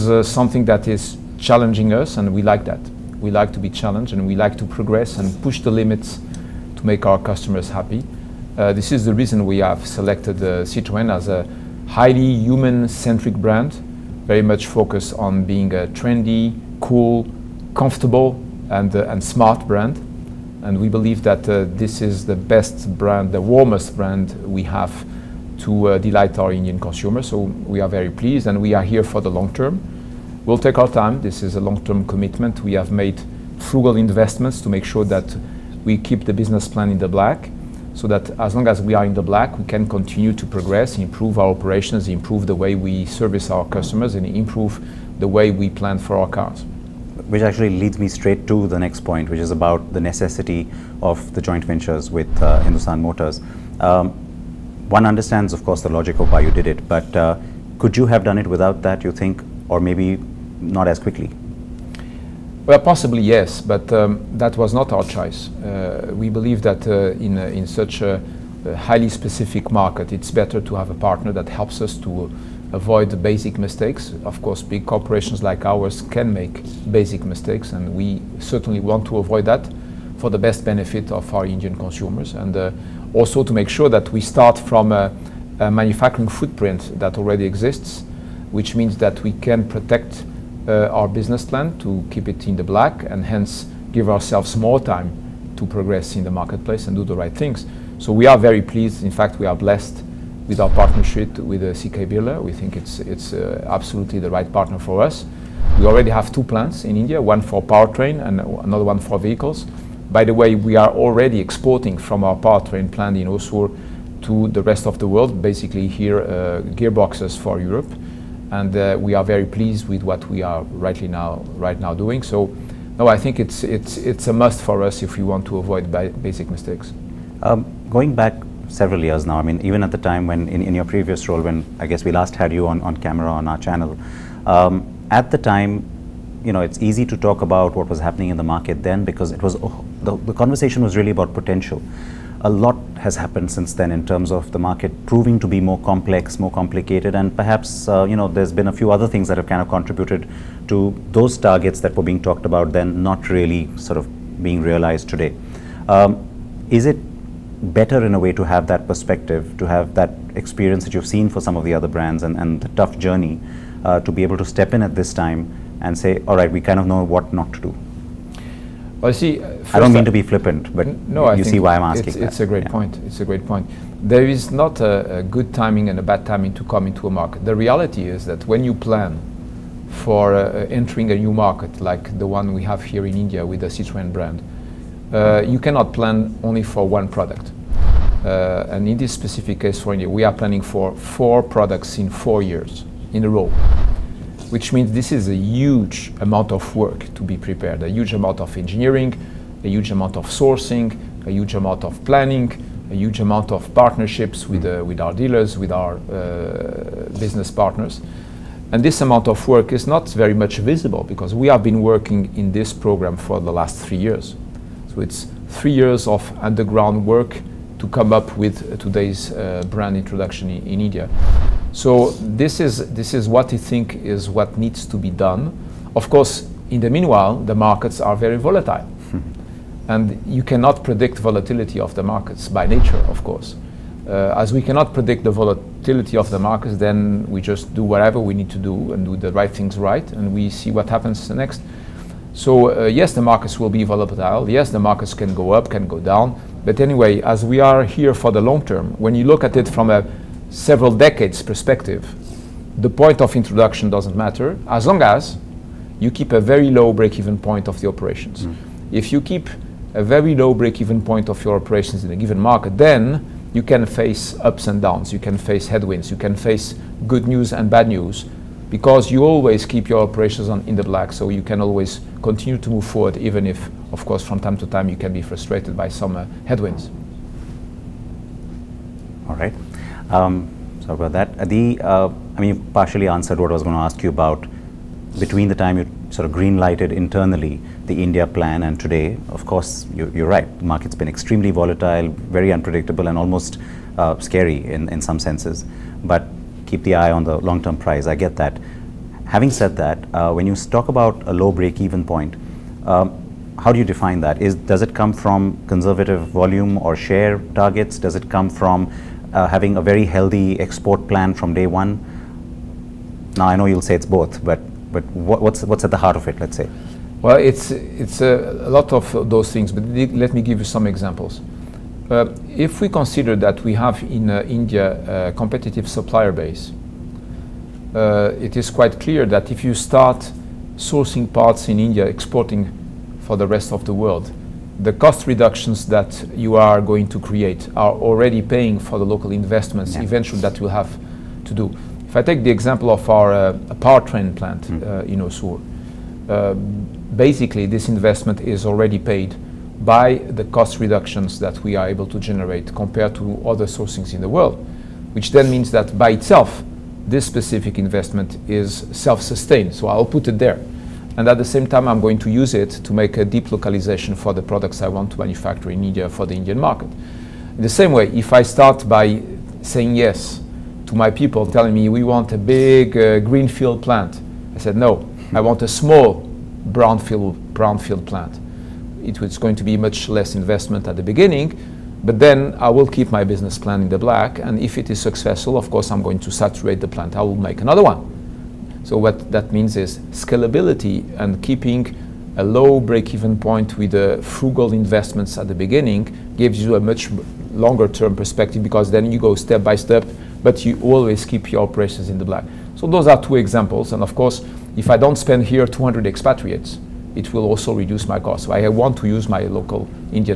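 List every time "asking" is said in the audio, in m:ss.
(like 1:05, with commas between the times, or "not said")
2:51.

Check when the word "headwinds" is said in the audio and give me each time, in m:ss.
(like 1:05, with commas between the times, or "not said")
4:25, 4:36.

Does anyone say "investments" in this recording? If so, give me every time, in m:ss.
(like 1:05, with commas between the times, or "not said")
0:33, 5:39, 5:47, 5:57, 6:20, 6:34.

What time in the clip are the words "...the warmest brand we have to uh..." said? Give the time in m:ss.
0:23.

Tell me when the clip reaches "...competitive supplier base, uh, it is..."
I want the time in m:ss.
5:25.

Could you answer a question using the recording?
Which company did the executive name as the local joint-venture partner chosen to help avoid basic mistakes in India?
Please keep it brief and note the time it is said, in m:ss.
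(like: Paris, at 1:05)
Hindustan Motors, at 0:52.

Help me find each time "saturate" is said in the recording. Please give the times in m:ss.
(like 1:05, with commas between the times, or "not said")
6:26.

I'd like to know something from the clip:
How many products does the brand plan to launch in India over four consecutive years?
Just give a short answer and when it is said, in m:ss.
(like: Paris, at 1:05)
4, at 3:10.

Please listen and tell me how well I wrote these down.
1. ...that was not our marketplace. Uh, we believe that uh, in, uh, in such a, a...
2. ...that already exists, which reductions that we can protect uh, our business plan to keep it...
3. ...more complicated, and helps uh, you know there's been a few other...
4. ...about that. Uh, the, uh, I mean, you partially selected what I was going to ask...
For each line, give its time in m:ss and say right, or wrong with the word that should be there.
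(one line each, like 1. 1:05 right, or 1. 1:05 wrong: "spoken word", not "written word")
1. 1:04 wrong: "choice", not "marketplace"
2. 1:26 wrong: "means", not "reductions"
3. 2:26 wrong: "perhaps", not "helps"
4. 4:41 wrong: "answered", not "selected".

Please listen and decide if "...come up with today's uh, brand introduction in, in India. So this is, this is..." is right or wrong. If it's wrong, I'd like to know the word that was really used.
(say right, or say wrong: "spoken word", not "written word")
right.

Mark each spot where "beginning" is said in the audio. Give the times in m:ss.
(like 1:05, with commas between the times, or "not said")
6:21, 6:35.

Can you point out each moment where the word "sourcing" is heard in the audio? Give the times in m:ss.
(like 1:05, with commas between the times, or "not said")
3:20, 5:30, 5:53.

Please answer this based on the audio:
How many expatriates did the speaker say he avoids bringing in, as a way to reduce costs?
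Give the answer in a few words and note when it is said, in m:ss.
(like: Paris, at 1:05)
200, at 6:45.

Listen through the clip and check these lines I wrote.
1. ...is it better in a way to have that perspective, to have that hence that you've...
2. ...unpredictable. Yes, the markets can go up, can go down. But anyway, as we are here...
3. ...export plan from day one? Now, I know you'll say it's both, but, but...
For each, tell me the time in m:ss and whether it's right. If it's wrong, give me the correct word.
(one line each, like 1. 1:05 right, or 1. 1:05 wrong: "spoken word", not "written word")
1. 2:36 wrong: "experience", not "hence"
2. 4:03 wrong: "volatile", not "unpredictable"
3. 5:10 right.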